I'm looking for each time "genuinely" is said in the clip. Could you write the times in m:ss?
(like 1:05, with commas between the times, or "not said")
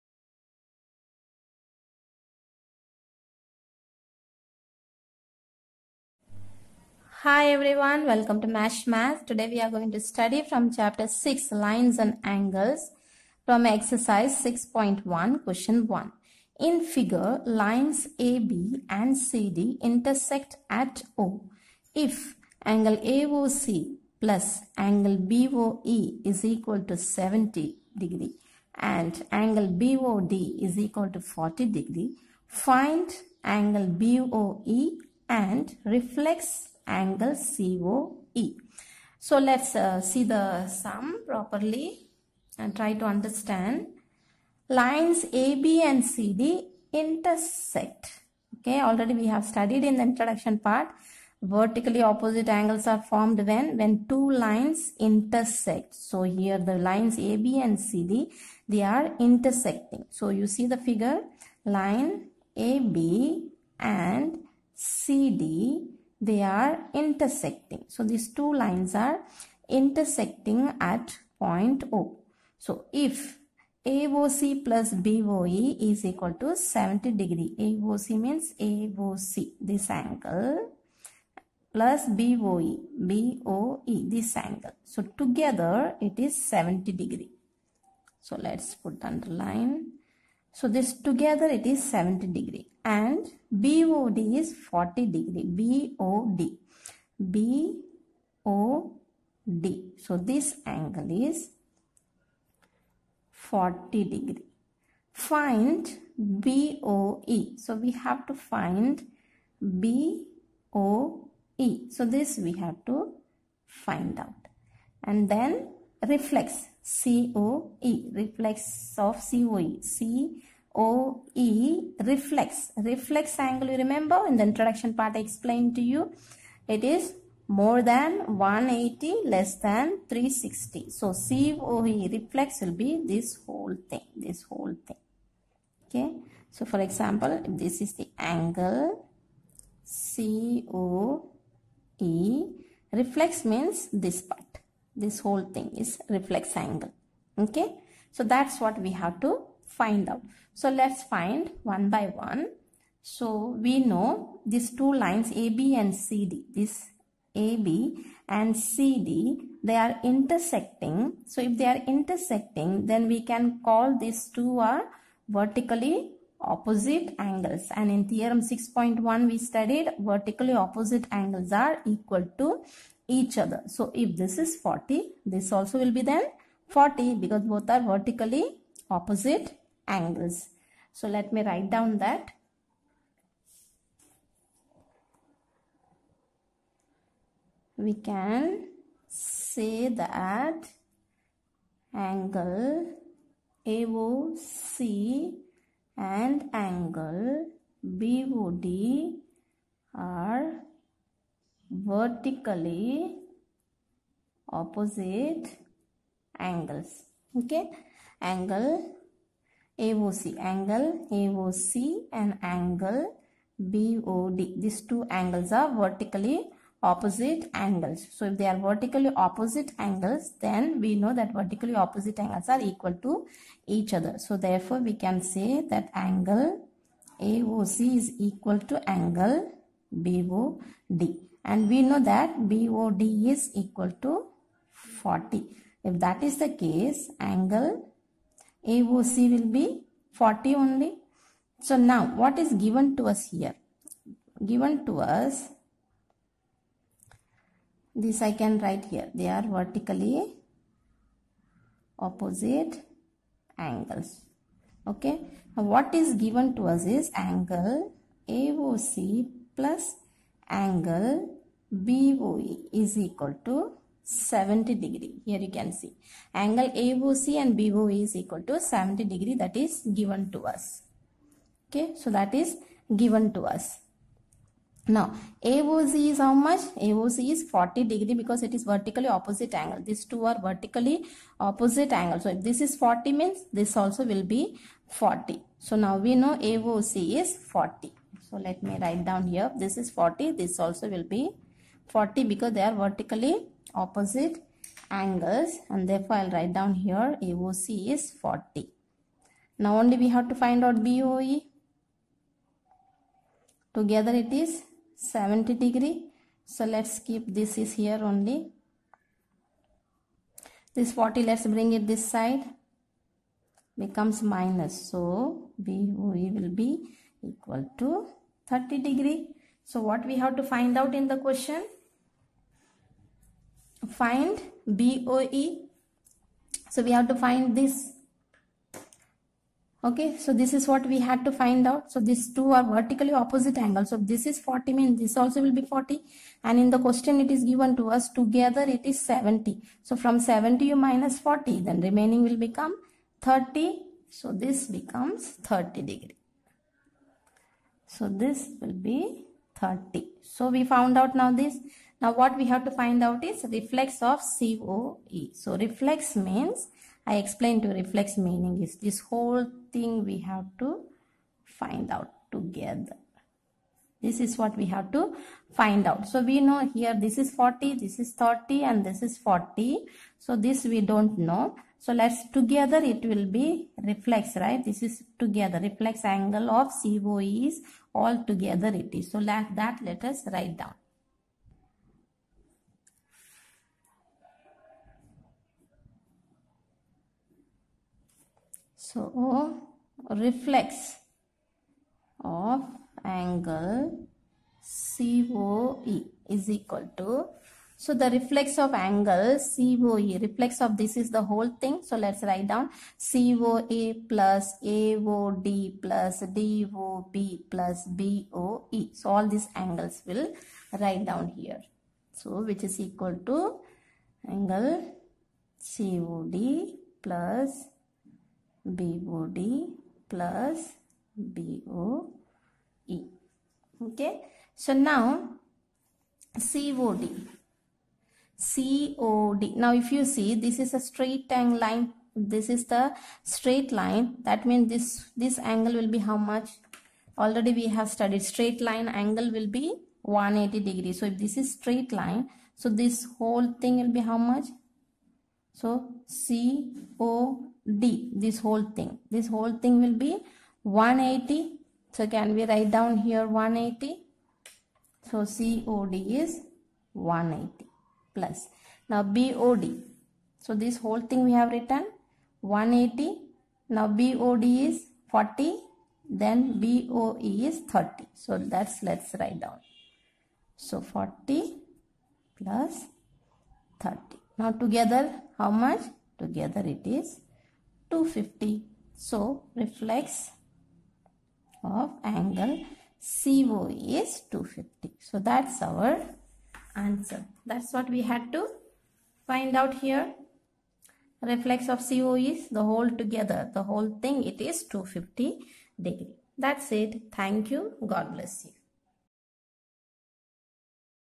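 not said.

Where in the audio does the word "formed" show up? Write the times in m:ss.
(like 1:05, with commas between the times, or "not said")
0:53.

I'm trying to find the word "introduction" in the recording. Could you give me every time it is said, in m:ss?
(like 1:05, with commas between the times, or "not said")
0:50, 2:04.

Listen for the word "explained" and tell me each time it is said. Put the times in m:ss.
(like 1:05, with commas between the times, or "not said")
2:05, 5:57.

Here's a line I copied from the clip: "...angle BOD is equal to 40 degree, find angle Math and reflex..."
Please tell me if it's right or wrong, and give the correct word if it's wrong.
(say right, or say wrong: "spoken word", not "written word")
wrong: "BOE", not "Math".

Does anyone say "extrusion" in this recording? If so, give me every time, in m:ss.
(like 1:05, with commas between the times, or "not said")
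not said.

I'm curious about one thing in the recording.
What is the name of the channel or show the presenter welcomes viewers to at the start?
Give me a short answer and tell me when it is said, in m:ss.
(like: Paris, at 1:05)
Mash Math, at 0:08.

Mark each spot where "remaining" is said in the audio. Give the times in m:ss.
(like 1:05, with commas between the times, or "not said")
5:41.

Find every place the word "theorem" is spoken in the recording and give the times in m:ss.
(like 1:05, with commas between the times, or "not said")
2:48.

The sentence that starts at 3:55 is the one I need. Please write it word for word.
If that is the case, angle AOC will be 40 only.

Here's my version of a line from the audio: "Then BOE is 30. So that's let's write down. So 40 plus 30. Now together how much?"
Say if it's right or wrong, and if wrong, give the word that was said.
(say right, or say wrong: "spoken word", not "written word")
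right.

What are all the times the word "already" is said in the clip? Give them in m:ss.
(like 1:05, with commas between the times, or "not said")
0:48, 7:17.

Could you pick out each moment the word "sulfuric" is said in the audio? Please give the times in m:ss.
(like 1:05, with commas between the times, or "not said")
not said.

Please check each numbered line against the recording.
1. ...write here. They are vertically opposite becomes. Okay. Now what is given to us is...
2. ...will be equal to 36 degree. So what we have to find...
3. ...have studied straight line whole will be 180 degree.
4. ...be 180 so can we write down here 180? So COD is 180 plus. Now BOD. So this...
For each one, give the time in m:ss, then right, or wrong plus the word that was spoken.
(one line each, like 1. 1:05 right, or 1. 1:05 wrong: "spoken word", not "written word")
1. 4:08 wrong: "angles", not "becomes"
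2. 5:16 wrong: "30", not "36"
3. 7:17 wrong: "angle", not "whole"
4. 7:29 right.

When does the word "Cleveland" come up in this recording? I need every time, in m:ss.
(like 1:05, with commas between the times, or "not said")
not said.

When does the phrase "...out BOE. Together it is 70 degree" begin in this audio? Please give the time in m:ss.
5:00.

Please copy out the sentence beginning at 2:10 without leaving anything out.
So COE, reflex will be this whole thing, this whole thing.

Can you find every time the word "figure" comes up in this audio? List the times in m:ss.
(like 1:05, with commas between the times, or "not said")
0:16, 1:00.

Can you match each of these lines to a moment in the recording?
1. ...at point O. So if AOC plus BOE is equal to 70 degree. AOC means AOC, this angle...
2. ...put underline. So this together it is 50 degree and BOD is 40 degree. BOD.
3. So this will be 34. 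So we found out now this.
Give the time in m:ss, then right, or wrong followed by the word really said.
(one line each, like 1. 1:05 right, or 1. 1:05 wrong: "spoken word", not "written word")
1. 1:10 right
2. 1:28 wrong: "70", not "50"
3. 5:47 wrong: "30", not "34".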